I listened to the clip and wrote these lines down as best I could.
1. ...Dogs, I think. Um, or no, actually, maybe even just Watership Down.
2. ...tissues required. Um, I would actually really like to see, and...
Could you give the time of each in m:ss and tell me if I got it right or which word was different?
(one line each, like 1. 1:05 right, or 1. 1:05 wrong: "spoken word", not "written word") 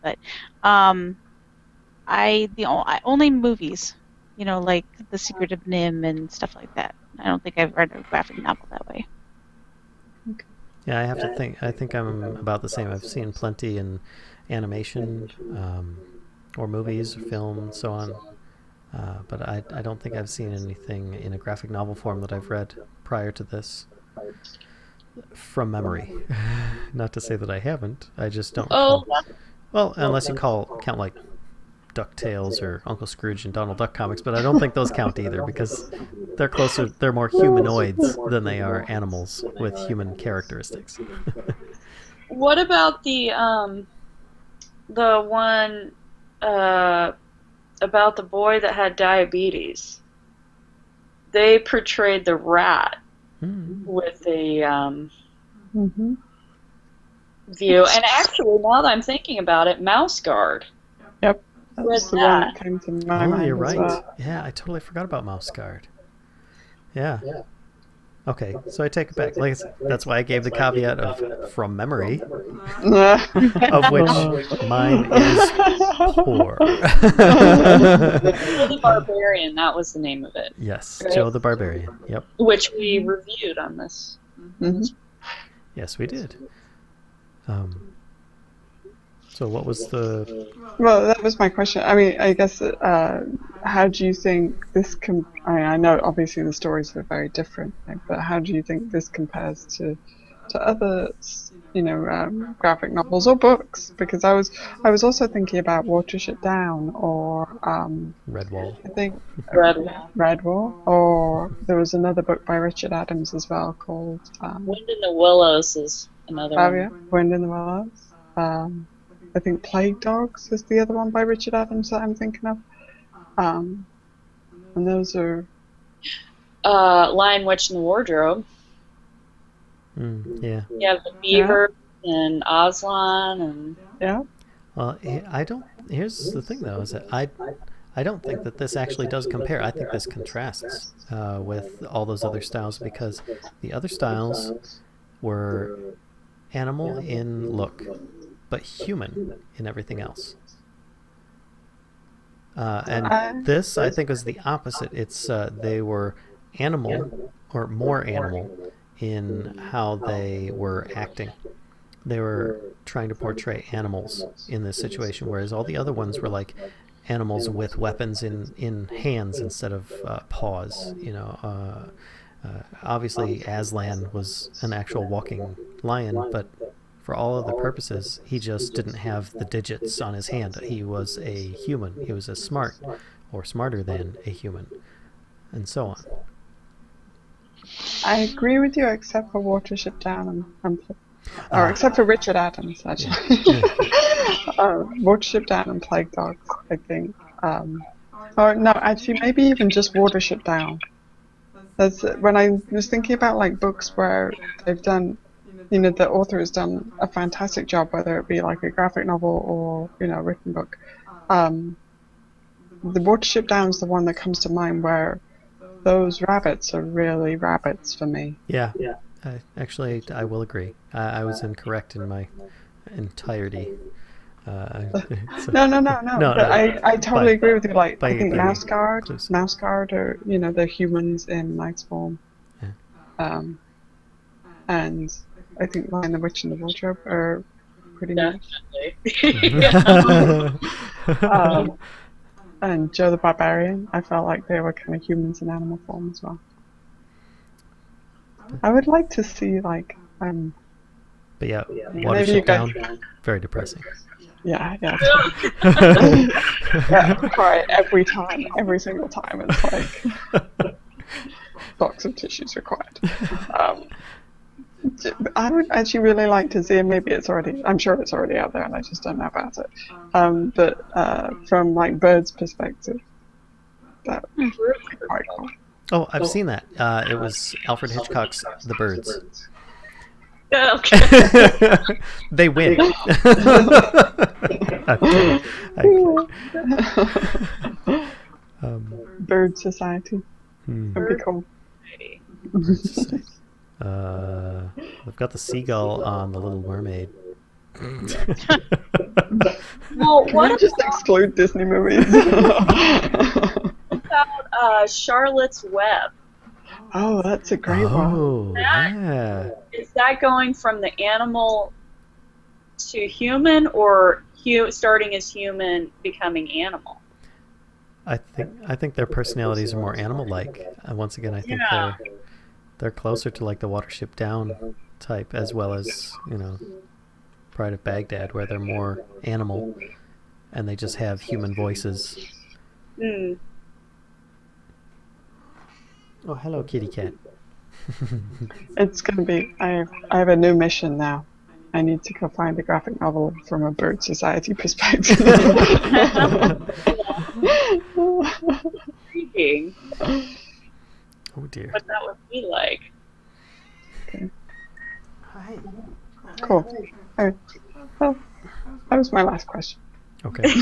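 1. 3:16 right
2. 4:22 right.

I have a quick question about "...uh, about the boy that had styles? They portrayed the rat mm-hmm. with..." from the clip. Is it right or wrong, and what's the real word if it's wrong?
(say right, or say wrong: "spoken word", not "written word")
wrong: "diabetes", not "styles".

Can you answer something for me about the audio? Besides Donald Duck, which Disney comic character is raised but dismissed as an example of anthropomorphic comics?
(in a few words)
Uncle Scrooge.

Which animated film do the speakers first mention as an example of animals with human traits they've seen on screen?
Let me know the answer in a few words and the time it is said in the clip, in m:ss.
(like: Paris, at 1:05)
The Secret of NIMH, at 0:05.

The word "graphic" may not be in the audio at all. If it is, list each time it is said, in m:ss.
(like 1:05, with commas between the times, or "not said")
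0:08, 0:21, 1:42, 3:28, 5:42.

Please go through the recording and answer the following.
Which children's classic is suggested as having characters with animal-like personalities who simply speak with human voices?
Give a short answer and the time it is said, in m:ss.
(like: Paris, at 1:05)
Charlotte's Web, at 5:04.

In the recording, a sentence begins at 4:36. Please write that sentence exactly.
Uh, it was Alfred Hitchcock's The Birds.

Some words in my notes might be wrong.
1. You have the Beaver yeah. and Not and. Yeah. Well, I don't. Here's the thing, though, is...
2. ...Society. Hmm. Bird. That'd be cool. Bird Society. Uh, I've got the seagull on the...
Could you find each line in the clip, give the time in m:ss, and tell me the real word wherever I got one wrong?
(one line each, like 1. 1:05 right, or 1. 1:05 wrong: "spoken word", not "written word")
1. 2:10 wrong: "Aslan", not "Not"
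2. 4:49 right.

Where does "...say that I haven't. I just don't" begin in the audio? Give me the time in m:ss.
0:27.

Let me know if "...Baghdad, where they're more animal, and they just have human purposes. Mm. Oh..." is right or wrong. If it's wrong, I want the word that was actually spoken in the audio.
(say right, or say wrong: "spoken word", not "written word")
wrong: "voices", not "purposes".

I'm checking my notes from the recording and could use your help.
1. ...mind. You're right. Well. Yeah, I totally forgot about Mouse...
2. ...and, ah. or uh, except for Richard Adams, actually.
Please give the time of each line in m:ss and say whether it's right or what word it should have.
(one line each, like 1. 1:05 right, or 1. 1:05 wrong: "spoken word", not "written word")
1. 1:03 right
2. 3:10 right.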